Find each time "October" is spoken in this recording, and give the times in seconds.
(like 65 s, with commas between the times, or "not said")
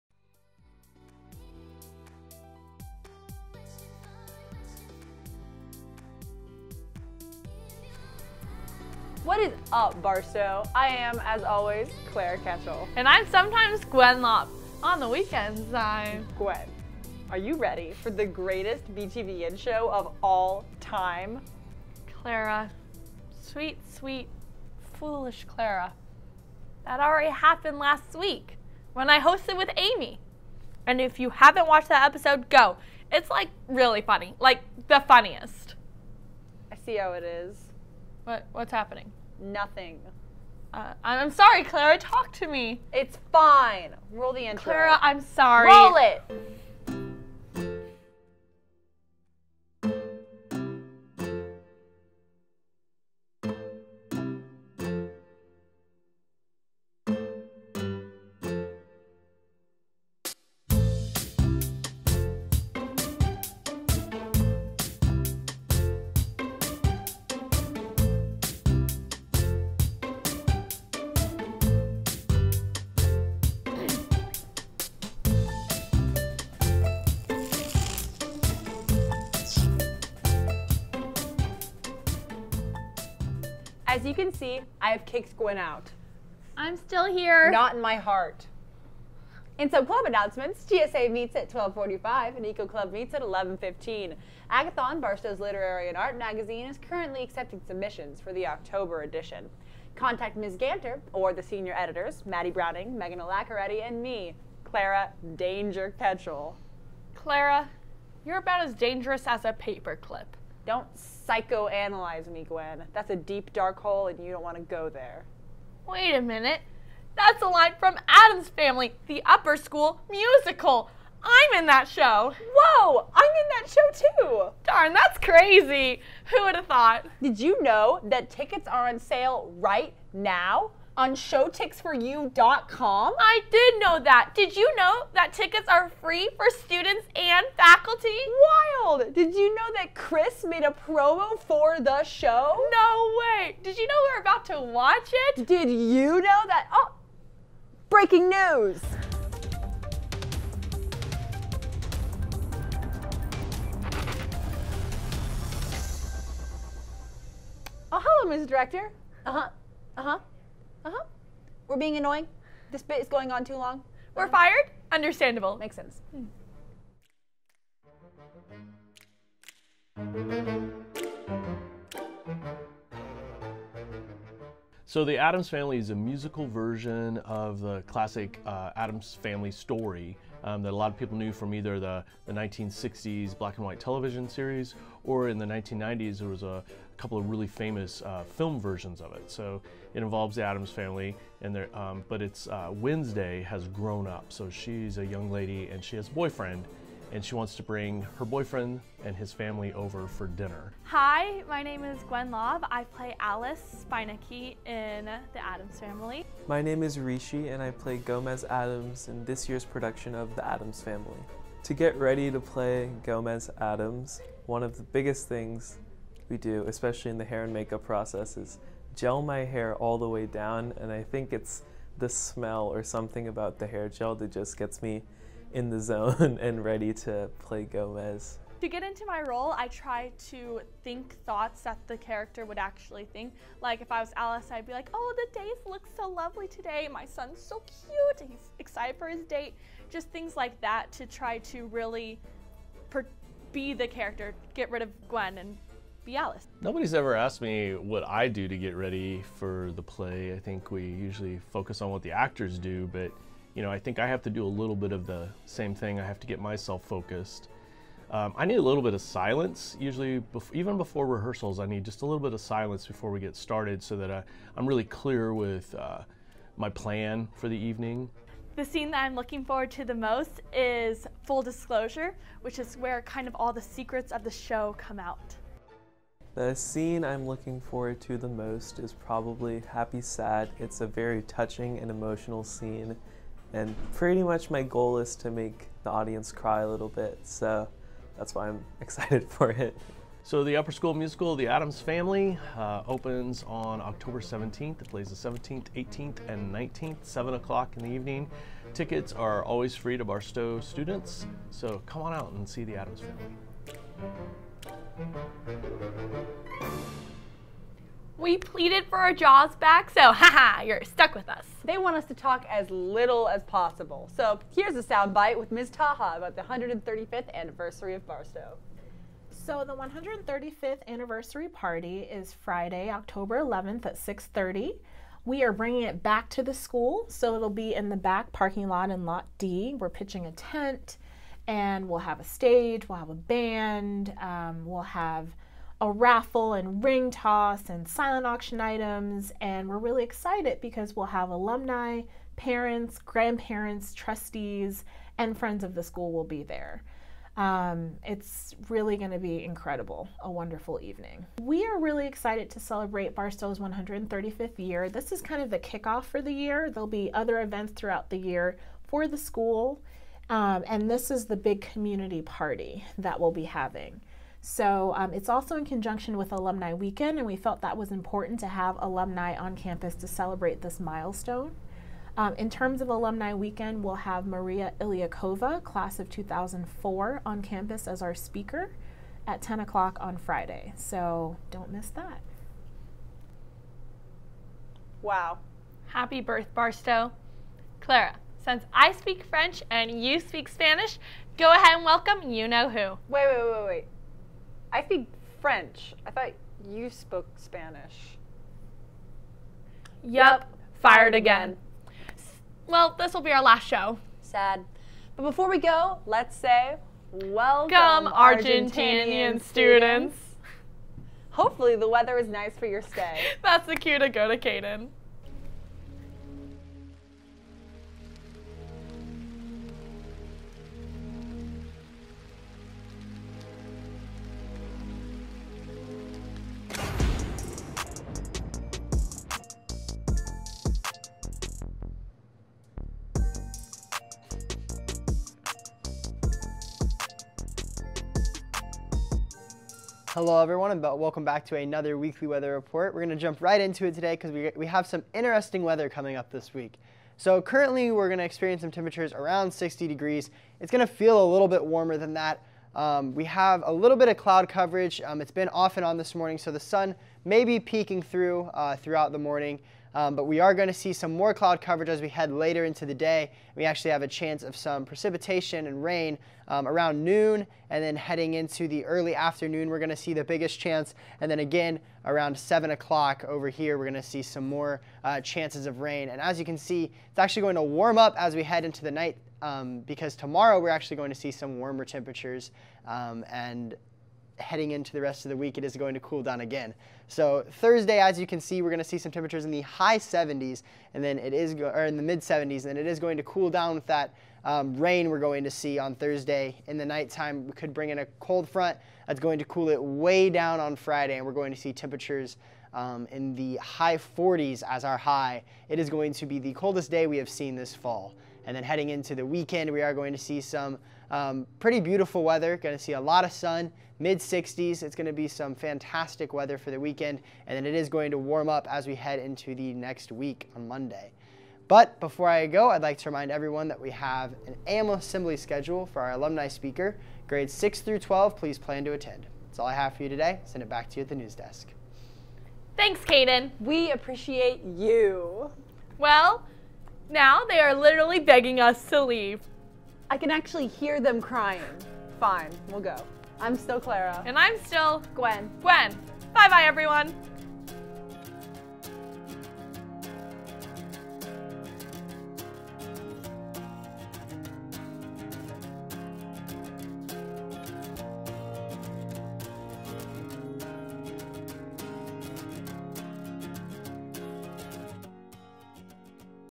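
98 s, 293 s, 322 s.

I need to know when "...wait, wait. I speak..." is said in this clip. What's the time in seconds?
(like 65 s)
393 s.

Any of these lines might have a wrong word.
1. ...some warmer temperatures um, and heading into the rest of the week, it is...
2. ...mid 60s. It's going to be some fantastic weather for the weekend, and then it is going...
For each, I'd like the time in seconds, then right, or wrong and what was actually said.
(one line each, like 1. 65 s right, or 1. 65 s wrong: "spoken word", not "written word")
1. 481 s right
2. 513 s right.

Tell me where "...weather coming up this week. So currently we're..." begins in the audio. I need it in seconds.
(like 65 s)
445 s.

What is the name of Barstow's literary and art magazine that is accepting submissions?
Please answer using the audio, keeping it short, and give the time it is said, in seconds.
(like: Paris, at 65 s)
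Agathon, at 94 s.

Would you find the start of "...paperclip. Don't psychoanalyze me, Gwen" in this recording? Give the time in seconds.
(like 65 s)
109 s.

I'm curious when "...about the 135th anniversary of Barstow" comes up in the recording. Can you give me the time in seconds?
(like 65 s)
316 s.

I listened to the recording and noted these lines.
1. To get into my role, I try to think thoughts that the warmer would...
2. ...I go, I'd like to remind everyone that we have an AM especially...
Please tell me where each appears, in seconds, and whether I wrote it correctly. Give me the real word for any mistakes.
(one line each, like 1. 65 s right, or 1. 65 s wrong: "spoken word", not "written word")
1. 228 s wrong: "character", not "warmer"
2. 522 s wrong: "assembly", not "especially".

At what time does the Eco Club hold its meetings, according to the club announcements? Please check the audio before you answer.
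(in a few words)
11:15.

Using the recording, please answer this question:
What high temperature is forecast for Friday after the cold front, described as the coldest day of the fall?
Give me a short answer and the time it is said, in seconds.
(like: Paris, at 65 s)
high 40s, at 503 s.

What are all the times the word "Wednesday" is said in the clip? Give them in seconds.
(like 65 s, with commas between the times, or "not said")
192 s.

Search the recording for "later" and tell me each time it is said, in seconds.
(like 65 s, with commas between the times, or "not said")
462 s.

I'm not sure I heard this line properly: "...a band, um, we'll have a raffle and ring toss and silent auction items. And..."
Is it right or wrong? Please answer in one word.
right.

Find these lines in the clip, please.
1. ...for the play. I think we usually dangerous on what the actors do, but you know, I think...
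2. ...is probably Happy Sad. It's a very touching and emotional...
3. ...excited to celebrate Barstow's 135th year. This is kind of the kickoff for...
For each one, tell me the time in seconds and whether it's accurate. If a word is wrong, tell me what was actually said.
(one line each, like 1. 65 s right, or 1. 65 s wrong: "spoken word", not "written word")
1. 249 s wrong: "focus", not "dangerous"
2. 278 s right
3. 352 s right.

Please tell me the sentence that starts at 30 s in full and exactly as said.
And if you haven't watched that episode, go.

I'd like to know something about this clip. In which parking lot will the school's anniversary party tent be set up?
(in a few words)
Lot D.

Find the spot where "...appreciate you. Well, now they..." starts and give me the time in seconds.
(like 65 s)
533 s.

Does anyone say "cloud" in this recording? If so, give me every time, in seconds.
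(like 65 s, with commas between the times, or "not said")
454 s, 461 s.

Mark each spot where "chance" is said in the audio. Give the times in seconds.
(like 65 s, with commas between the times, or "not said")
464 s, 470 s, 475 s.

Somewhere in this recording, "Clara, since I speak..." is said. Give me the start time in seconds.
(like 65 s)
387 s.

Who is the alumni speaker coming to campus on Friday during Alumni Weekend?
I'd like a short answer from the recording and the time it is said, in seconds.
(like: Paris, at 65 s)
Maria Ilyakova, at 374 s.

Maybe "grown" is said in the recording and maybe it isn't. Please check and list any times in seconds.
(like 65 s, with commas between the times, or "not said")
193 s.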